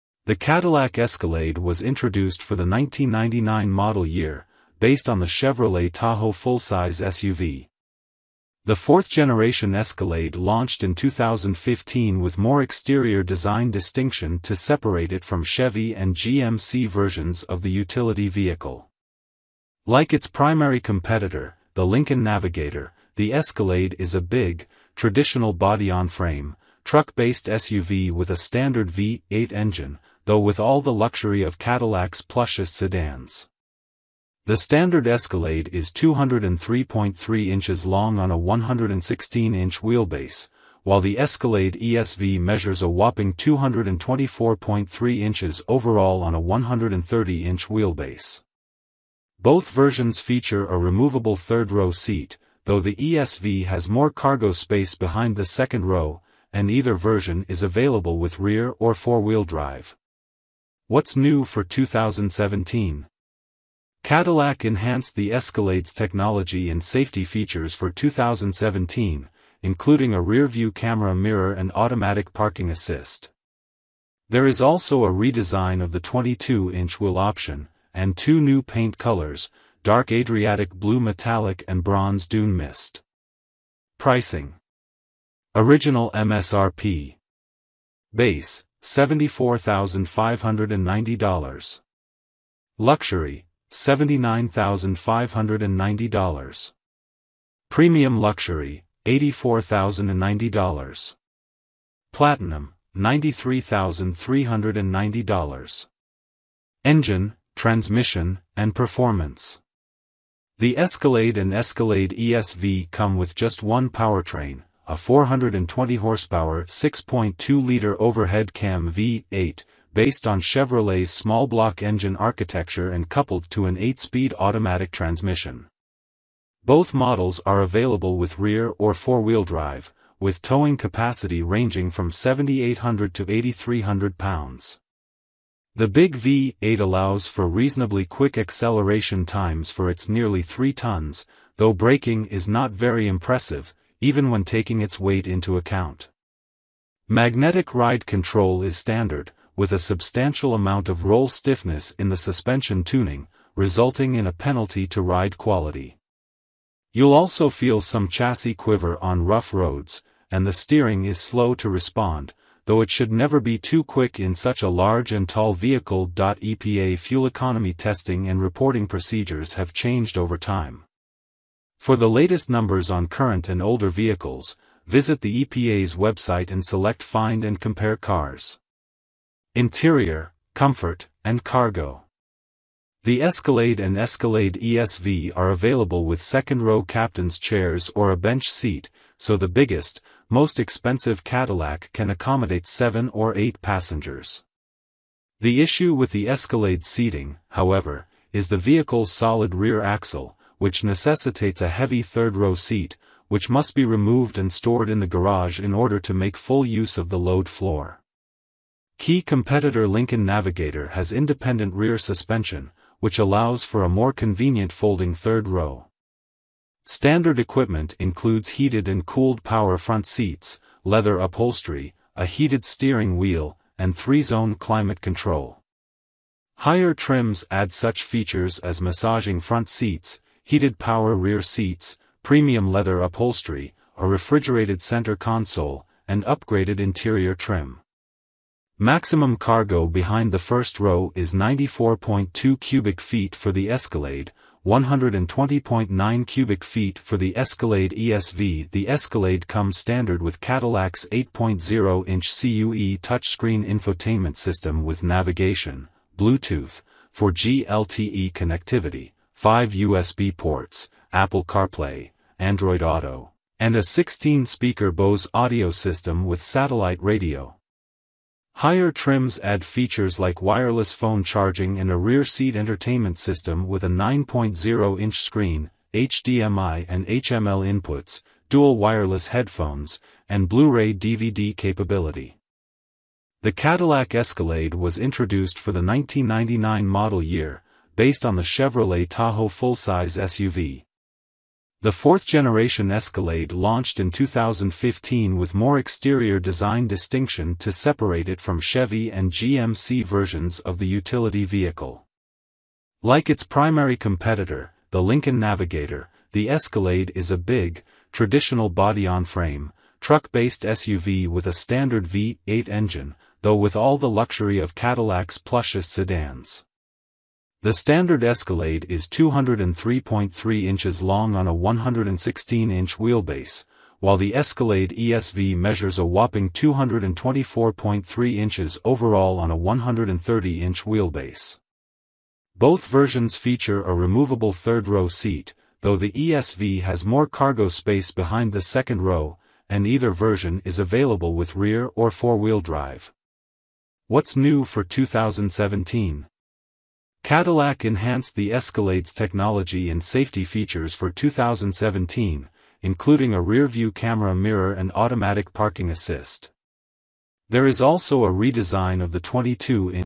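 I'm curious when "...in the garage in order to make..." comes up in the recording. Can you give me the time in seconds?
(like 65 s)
204 s.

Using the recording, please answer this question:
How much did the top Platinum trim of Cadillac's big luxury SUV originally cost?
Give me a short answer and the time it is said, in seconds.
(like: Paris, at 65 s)
$93,390, at 102 s.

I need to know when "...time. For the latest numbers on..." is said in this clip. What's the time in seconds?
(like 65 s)
170 s.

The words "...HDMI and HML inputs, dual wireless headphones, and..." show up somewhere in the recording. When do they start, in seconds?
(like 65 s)
275 s.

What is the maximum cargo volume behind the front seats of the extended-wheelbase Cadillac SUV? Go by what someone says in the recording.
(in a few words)
120.9 cubic feet.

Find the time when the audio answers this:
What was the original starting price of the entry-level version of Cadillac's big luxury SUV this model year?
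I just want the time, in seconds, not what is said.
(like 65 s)
88 s.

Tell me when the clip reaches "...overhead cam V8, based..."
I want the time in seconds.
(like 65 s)
118 s.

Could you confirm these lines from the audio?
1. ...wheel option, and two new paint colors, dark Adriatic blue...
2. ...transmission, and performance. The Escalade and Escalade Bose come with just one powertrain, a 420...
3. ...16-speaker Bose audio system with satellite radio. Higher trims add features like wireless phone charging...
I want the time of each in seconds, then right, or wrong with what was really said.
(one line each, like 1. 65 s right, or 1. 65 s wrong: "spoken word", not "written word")
1. 76 s right
2. 107 s wrong: "ESV", not "Bose"
3. 263 s right.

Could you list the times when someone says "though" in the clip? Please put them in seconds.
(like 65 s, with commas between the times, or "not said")
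30 s, 52 s, 141 s, 162 s, 313 s, 335 s.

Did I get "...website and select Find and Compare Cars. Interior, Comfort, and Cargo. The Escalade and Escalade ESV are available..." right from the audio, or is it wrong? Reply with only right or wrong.
right.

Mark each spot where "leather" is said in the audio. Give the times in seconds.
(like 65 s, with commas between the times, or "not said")
220 s, 232 s.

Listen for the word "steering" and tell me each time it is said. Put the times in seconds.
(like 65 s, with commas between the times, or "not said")
160 s, 222 s.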